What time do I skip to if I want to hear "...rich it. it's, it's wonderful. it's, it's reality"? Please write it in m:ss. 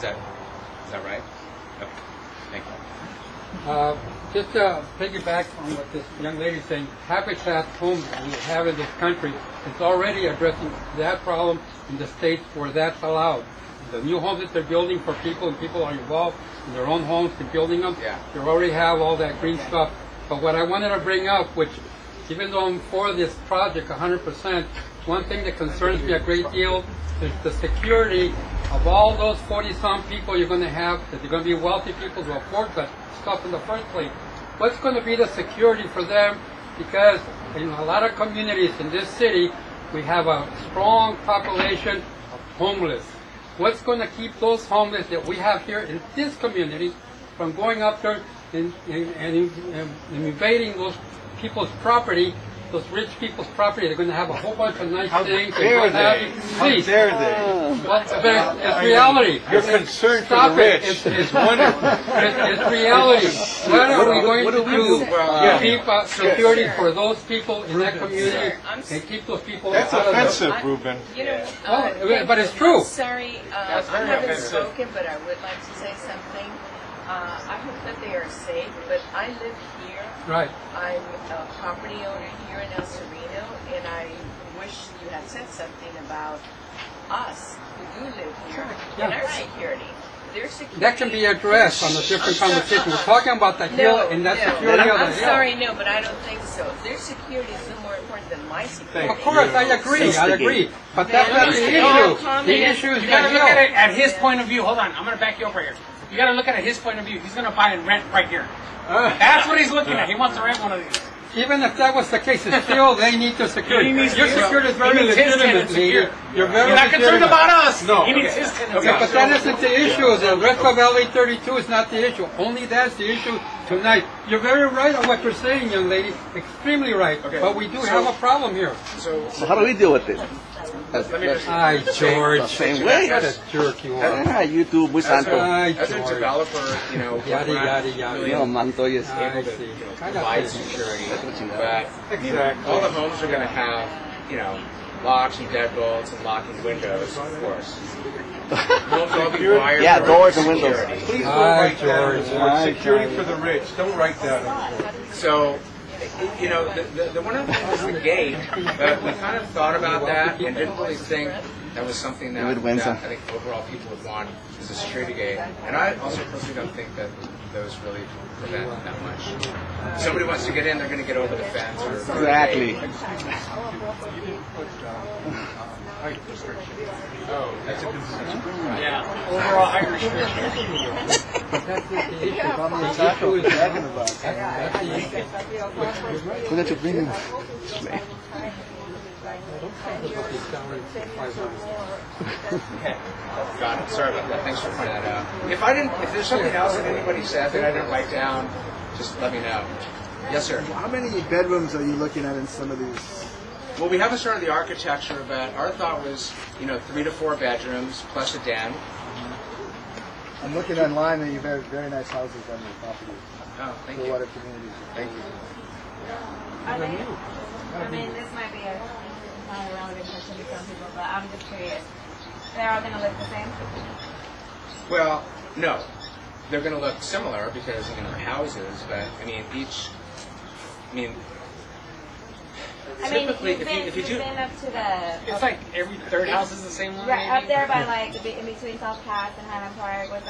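1:00.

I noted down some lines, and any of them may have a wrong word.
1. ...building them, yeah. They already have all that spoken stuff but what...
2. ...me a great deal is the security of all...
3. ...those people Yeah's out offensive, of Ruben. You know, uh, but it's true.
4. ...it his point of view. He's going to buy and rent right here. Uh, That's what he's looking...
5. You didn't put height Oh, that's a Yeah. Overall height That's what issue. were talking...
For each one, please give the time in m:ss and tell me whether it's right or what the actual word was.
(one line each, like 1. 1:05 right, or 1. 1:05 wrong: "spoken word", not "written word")
1. 0:17 wrong: "green", not "spoken"
2. 0:26 right
3. 1:09 wrong: "That", not "Yeah"
4. 1:46 right
5. 2:52 right.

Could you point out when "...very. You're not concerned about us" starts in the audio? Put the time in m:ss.
1:56.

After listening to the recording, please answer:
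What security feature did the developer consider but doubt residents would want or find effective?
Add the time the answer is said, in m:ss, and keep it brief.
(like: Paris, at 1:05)
Security gate, at 2:44.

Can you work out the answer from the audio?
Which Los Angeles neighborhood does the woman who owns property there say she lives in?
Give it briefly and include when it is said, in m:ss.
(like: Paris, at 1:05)
El Sereno, at 1:22.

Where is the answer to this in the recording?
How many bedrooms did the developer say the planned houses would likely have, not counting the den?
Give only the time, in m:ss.
3:26.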